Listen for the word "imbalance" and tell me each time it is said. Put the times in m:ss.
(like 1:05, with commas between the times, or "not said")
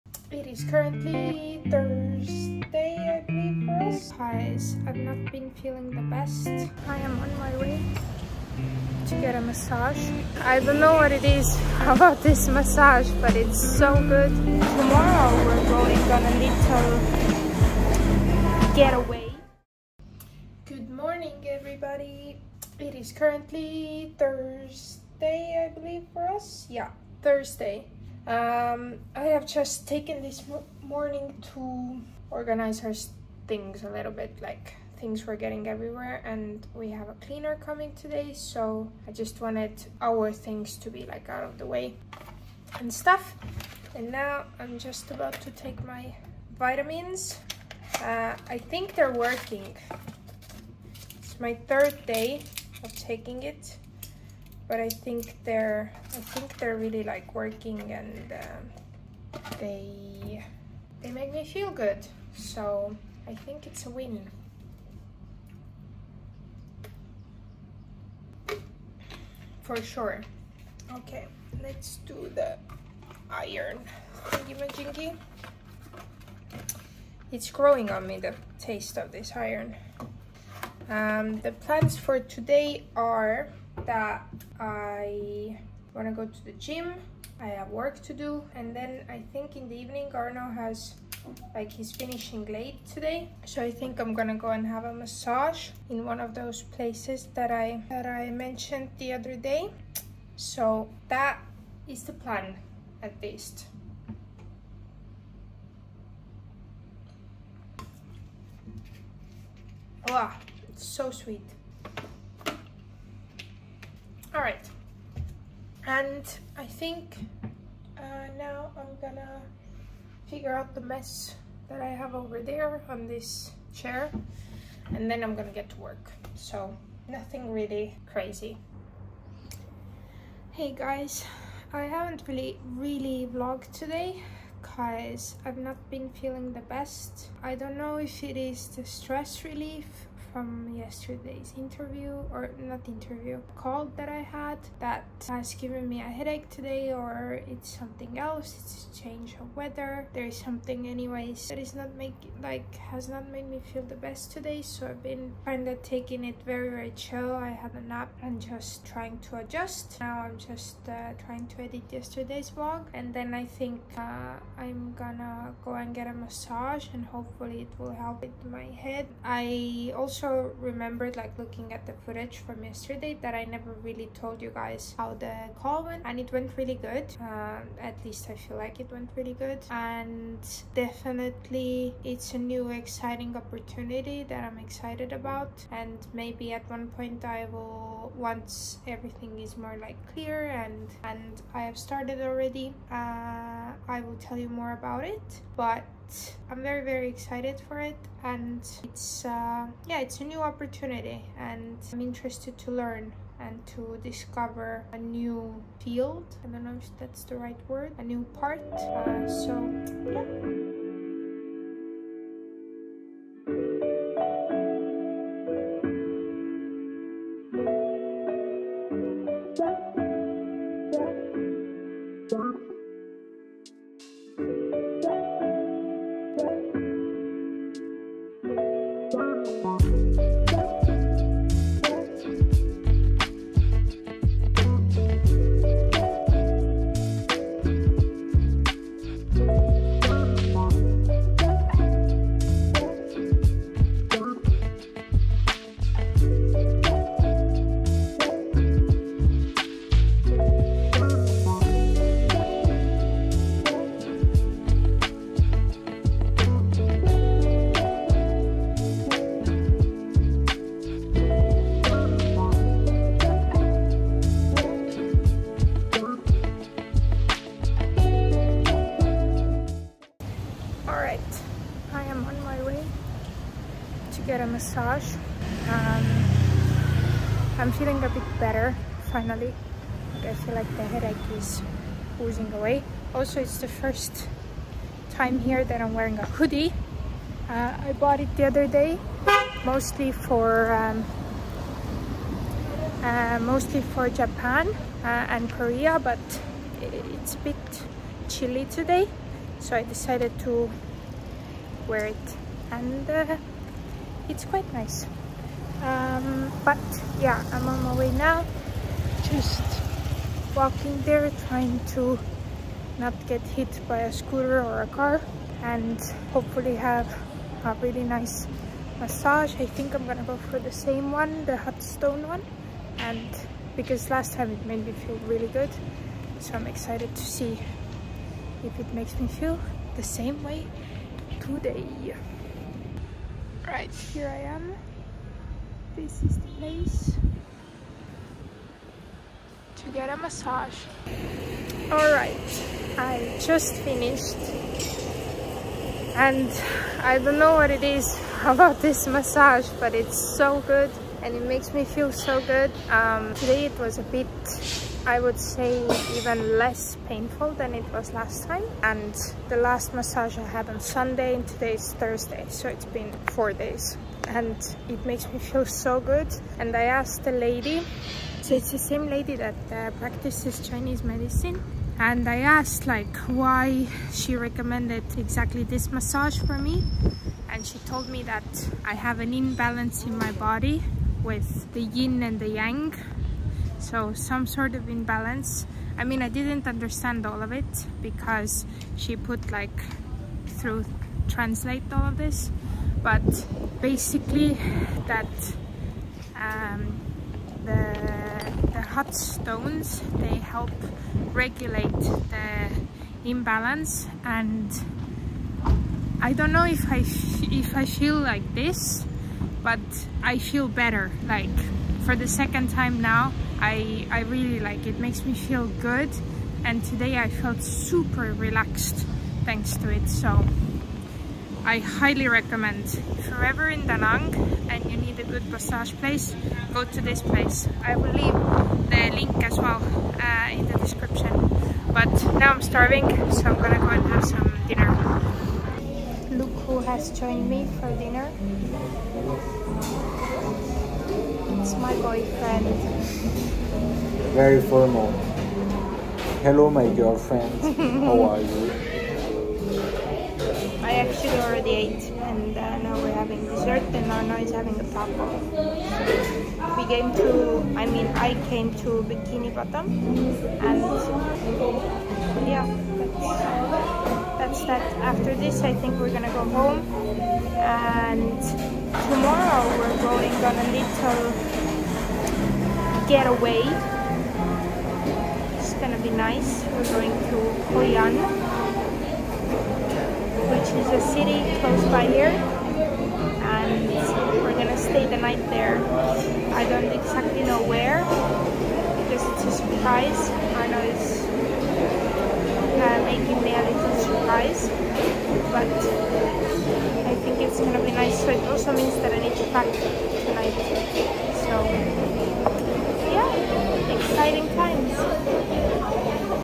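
6:19, 6:24, 6:43.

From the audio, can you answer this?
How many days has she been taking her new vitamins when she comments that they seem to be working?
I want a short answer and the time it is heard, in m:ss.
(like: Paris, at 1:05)
3, at 0:51.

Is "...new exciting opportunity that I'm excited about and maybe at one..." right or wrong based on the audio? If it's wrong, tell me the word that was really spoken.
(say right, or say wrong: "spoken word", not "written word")
right.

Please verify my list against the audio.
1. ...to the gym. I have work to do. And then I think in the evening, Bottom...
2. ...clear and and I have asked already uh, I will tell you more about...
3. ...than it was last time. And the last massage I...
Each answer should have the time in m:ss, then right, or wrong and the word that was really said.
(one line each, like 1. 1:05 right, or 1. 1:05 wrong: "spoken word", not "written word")
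1. 1:26 wrong: "Arno", not "Bottom"
2. 3:10 wrong: "started", not "asked"
3. 5:57 right.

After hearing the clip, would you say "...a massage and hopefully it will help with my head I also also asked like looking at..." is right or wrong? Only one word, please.
wrong.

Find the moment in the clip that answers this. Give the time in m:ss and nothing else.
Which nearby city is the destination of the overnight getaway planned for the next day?
7:57.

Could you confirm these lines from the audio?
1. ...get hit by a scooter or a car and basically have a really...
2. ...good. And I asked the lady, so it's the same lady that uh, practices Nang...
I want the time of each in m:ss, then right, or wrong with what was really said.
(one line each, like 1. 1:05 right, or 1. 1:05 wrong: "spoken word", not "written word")
1. 5:13 wrong: "hopefully", not "basically"
2. 6:05 wrong: "Chinese", not "Nang".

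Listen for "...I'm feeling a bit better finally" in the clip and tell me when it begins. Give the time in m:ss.
4:37.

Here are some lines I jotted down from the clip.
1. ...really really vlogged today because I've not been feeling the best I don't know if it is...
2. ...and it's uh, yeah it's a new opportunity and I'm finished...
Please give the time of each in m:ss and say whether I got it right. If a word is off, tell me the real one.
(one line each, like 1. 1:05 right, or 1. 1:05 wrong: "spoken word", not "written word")
1. 2:12 right
2. 3:18 wrong: "interested", not "finished".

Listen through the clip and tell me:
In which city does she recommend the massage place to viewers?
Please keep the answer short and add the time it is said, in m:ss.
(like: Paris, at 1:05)
Da Nang, at 7:03.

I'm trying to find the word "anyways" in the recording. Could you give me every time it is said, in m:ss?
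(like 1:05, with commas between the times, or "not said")
2:30.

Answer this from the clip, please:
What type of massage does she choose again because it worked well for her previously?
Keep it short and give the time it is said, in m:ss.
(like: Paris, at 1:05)
hot stone, at 5:21.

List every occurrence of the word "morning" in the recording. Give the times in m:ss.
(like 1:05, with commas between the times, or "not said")
0:20, 0:30.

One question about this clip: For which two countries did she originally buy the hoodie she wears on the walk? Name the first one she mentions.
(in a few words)
Japan.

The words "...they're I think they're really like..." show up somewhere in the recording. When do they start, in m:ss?
0:55.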